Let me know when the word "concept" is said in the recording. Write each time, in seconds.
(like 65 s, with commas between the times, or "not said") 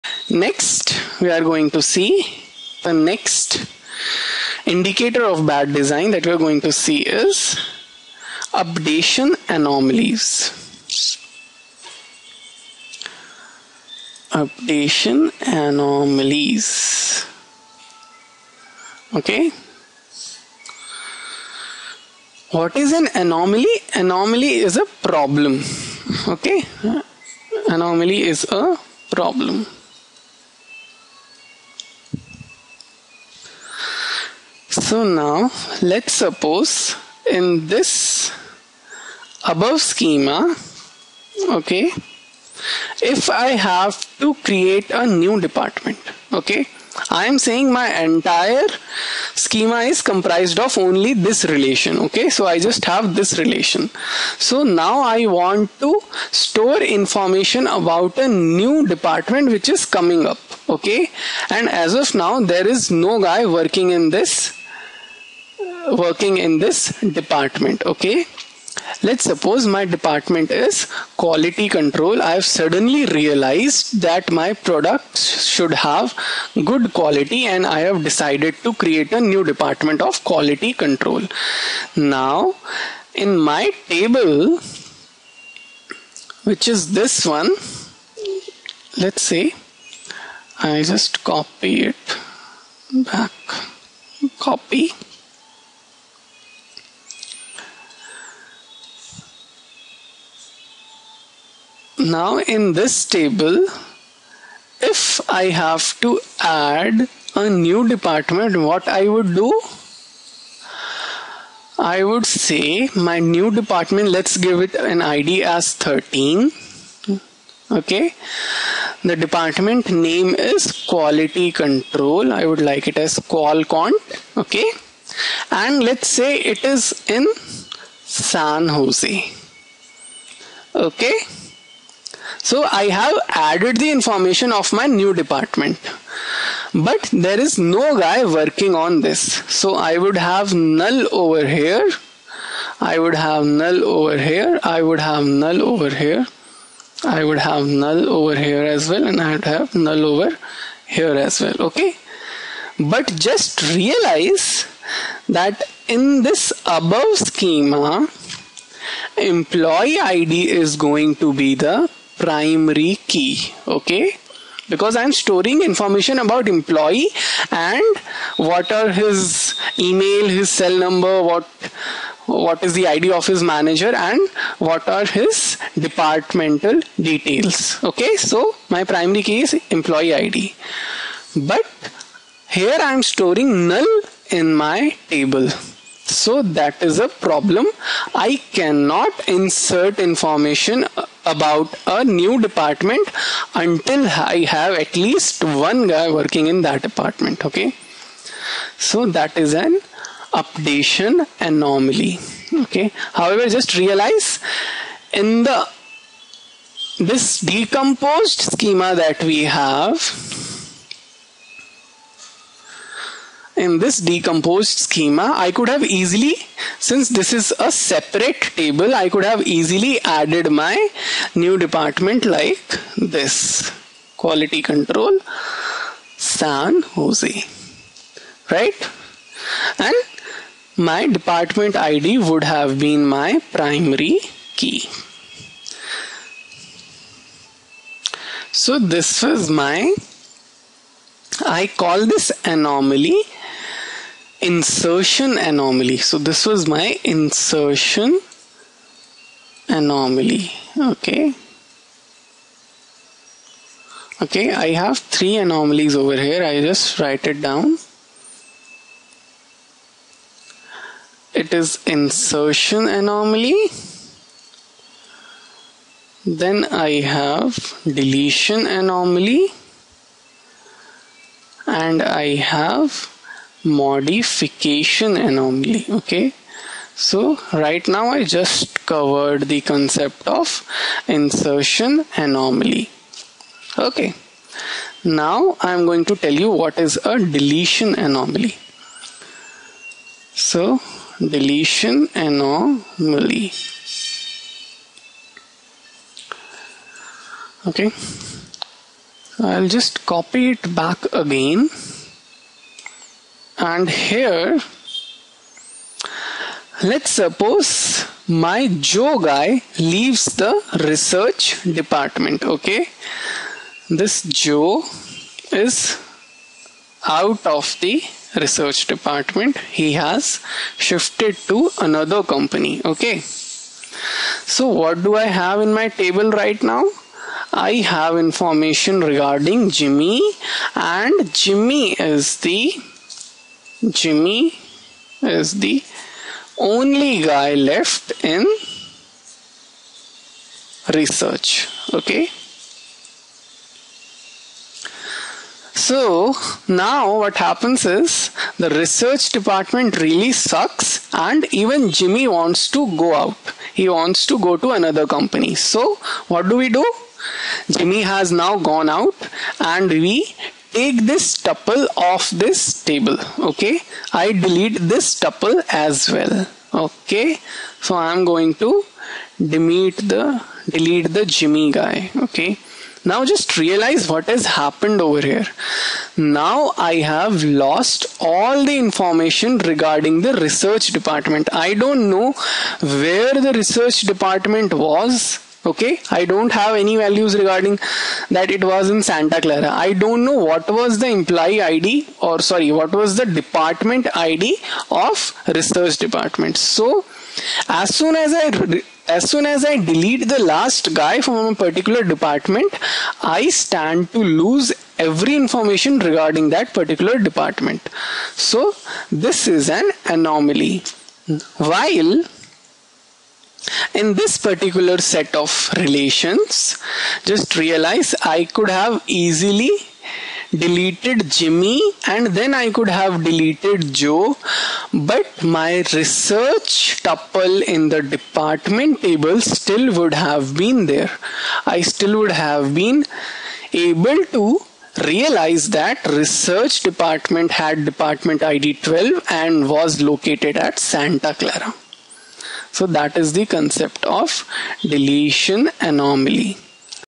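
279 s, 443 s.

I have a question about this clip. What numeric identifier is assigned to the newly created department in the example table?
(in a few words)
13.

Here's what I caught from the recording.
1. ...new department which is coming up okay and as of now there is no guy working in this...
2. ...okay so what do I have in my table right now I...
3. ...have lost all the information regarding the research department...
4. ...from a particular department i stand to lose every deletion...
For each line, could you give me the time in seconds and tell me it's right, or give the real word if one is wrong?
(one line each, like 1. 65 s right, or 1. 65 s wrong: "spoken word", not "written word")
1. 58 s right
2. 322 s right
3. 376 s right
4. 401 s wrong: "information", not "deletion".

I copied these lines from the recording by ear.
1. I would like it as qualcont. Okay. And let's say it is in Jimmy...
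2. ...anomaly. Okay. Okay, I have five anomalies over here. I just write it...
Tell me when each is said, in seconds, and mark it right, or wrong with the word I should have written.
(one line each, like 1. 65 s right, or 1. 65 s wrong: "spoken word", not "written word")
1. 122 s wrong: "San", not "Jimmy"
2. 249 s wrong: "three", not "five".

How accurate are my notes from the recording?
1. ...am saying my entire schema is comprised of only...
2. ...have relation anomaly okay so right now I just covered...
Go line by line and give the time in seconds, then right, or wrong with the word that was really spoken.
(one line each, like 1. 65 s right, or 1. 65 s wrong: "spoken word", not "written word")
1. 47 s right
2. 272 s wrong: "modification", not "relation".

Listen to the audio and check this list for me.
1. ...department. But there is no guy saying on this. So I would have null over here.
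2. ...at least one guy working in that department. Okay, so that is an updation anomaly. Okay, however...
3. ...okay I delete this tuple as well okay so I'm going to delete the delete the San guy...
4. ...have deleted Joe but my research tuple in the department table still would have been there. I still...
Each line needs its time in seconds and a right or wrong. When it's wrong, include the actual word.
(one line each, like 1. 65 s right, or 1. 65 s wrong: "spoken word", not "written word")
1. 135 s wrong: "working", not "saying"
2. 194 s right
3. 363 s wrong: "Jimmy", not "San"
4. 422 s right.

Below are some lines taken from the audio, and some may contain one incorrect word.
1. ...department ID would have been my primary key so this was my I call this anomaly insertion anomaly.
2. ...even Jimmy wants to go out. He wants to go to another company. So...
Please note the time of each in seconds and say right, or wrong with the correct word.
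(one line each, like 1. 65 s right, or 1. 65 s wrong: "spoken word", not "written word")
1. 231 s right
2. 351 s right.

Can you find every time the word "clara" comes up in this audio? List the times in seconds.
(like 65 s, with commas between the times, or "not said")
389 s, 441 s.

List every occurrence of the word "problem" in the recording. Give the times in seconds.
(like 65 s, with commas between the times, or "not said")
25 s, 29 s, 187 s.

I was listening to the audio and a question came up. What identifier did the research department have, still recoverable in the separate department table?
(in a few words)
12.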